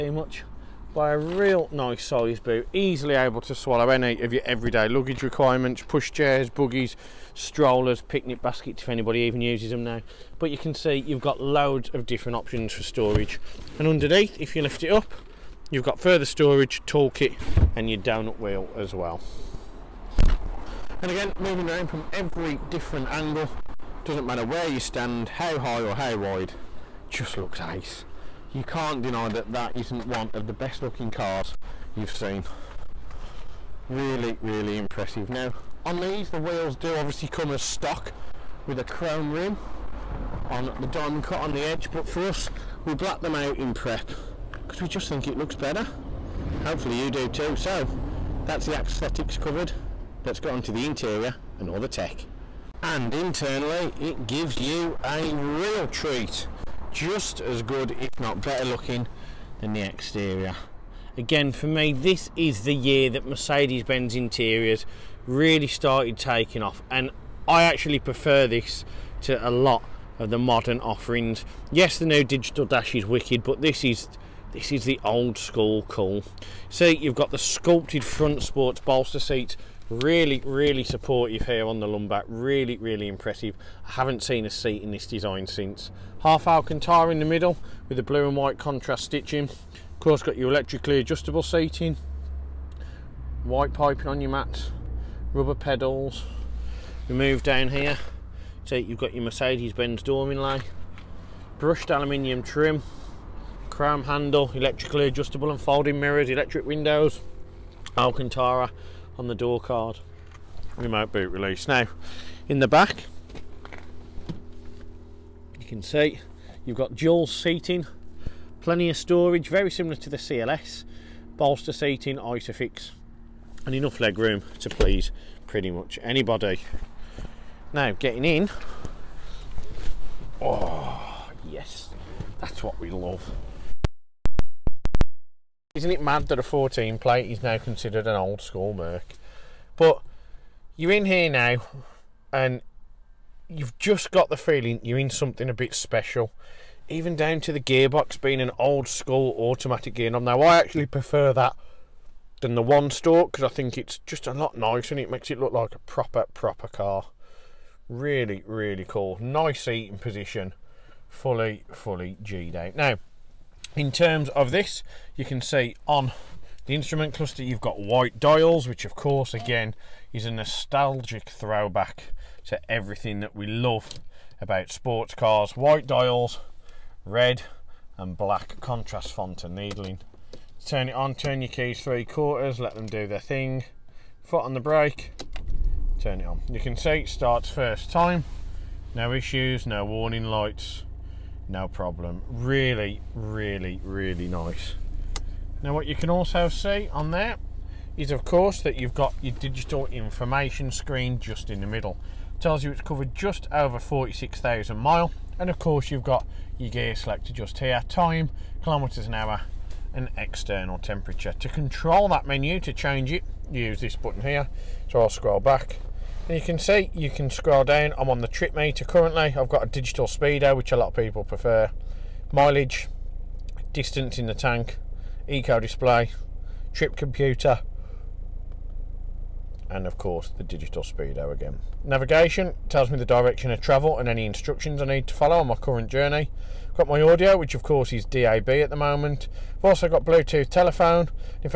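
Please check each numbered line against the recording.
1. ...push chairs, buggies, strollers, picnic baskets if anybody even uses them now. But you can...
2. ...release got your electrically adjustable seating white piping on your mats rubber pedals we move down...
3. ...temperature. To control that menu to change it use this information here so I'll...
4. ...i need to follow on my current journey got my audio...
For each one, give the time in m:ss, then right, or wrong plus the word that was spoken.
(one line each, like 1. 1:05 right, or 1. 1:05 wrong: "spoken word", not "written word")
1. 0:05 right
2. 1:29 wrong: "course", not "release"
3. 3:30 wrong: "button", not "information"
4. 3:54 right.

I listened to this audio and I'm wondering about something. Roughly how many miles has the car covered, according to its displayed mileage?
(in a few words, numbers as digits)
46,000.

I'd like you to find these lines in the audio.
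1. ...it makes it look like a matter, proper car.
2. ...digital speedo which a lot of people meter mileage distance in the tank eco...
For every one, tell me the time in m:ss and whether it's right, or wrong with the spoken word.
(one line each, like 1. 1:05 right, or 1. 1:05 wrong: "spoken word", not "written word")
1. 2:34 wrong: "proper", not "matter"
2. 3:39 wrong: "prefer", not "meter".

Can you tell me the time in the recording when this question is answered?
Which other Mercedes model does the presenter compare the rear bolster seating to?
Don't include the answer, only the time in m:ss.
2:00.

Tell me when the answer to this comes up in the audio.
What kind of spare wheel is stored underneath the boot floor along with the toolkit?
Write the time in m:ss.
0:17.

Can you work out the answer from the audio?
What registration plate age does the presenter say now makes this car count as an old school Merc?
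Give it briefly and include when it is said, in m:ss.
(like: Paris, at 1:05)
14 plate, at 2:16.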